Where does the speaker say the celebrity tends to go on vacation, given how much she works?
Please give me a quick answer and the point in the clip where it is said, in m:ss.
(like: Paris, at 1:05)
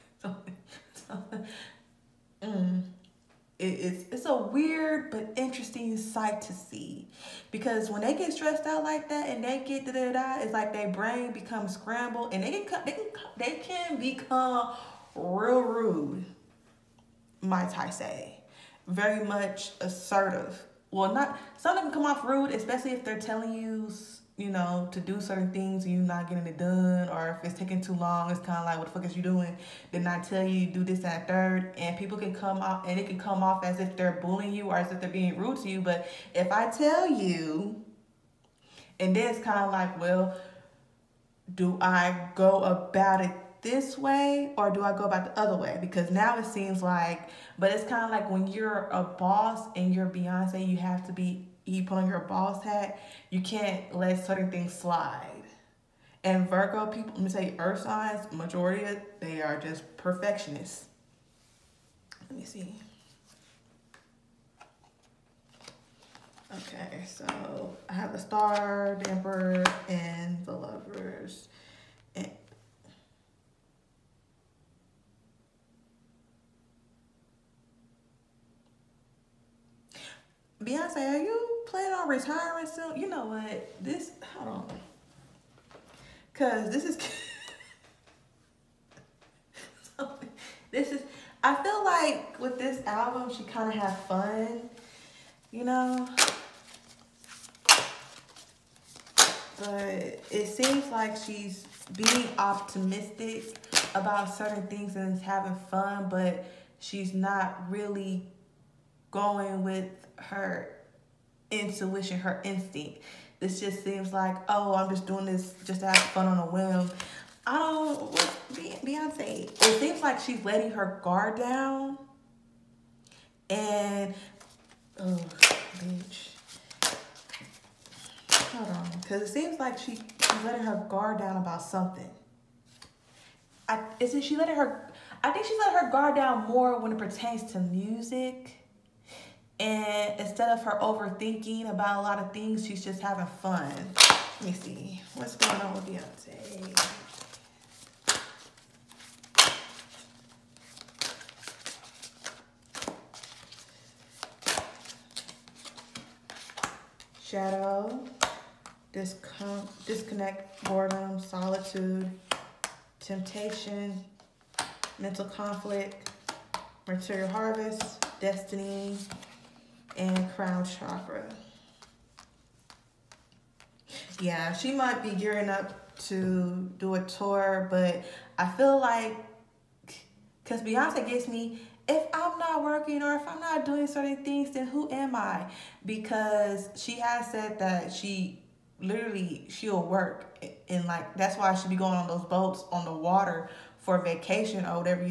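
Boats on the water, at 3:12.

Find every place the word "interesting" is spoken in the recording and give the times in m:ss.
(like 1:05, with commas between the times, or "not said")
0:05.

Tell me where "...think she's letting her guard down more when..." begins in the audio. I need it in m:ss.
2:15.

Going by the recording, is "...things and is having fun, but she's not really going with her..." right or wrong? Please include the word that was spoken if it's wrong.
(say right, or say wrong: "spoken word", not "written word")
right.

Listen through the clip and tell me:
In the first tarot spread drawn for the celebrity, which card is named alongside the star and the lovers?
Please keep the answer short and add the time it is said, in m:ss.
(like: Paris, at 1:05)
The Emperor, at 1:09.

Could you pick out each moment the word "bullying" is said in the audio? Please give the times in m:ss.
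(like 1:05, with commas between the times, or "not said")
0:34.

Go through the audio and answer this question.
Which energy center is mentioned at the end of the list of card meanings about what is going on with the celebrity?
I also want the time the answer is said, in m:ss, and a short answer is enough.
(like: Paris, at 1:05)
Crown chakra, at 2:50.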